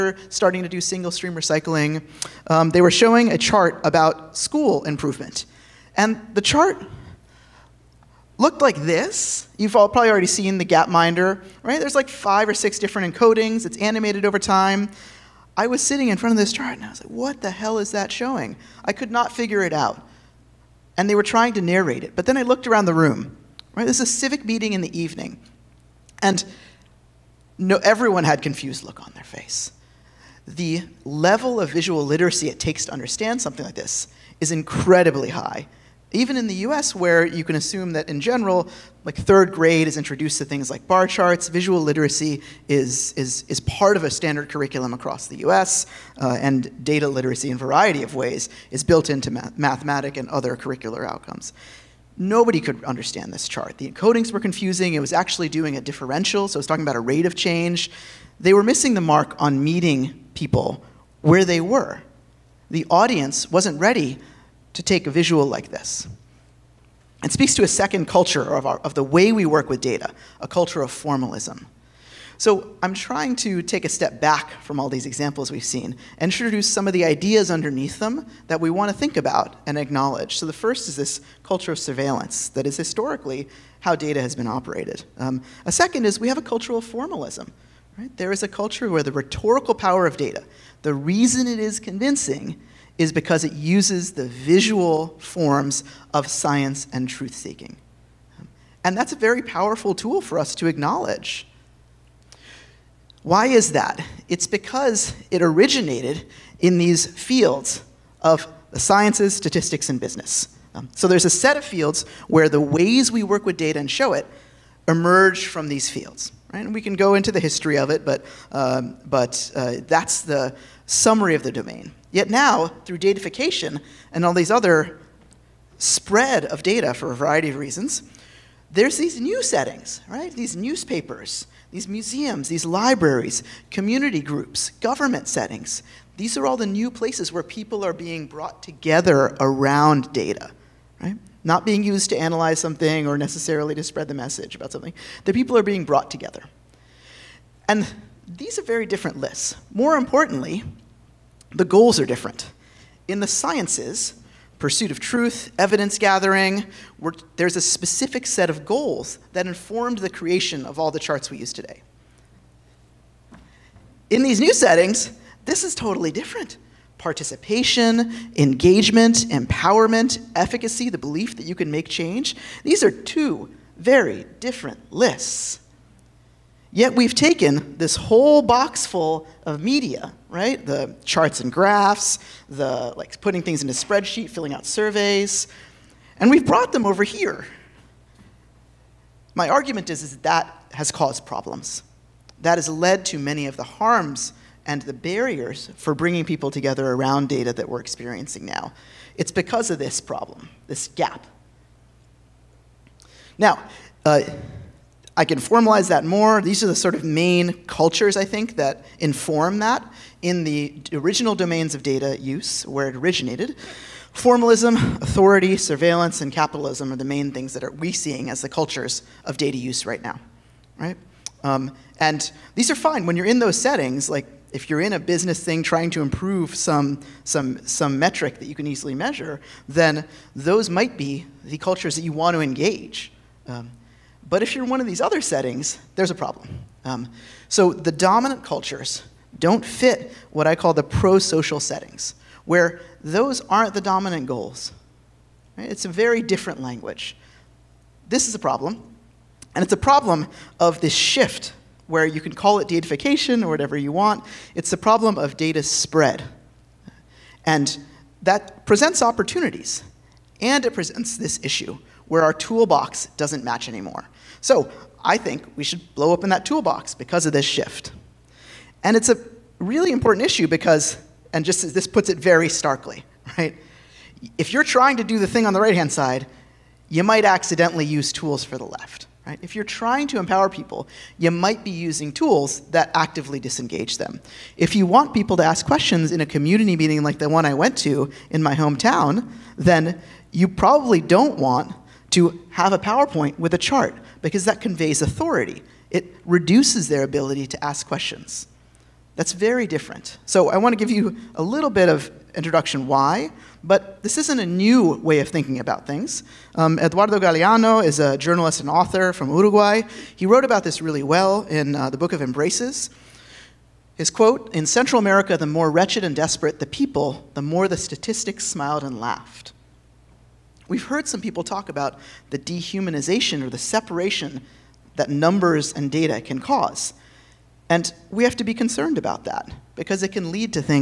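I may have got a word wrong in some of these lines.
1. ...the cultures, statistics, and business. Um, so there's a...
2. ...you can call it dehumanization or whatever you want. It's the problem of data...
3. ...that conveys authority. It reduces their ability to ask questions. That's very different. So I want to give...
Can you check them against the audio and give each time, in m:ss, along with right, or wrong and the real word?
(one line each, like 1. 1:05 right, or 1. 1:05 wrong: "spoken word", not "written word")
1. 1:48 wrong: "sciences", not "cultures"
2. 4:12 wrong: "datification", not "dehumanization"
3. 4:54 right.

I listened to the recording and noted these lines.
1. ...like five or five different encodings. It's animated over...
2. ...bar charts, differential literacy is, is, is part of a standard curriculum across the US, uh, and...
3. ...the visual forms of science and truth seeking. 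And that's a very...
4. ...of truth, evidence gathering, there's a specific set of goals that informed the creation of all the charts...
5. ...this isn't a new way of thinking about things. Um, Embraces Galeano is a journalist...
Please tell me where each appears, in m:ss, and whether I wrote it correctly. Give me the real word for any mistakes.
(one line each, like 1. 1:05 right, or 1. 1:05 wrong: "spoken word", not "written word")
1. 0:11 wrong: "six", not "five"
2. 0:40 wrong: "visual", not "differential"
3. 1:34 right
4. 2:34 right
5. 5:04 wrong: "Eduardo", not "Embraces".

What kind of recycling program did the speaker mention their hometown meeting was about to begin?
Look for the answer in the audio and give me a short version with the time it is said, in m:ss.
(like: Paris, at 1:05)
Single stream recycling, at 0:00.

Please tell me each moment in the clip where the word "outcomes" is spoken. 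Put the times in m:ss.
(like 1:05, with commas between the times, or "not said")
0:51.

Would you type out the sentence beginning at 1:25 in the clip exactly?
Um, a second is we have a culture of formalism.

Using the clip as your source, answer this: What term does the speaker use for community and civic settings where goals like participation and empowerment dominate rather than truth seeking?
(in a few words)
Pro social settings.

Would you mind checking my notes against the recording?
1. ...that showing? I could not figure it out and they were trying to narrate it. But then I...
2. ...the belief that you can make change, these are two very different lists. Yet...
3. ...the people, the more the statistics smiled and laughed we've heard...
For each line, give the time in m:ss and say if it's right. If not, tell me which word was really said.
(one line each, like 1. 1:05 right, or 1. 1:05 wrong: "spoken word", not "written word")
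1. 0:17 right
2. 2:50 right
3. 5:16 right.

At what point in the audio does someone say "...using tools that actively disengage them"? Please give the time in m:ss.
4:41.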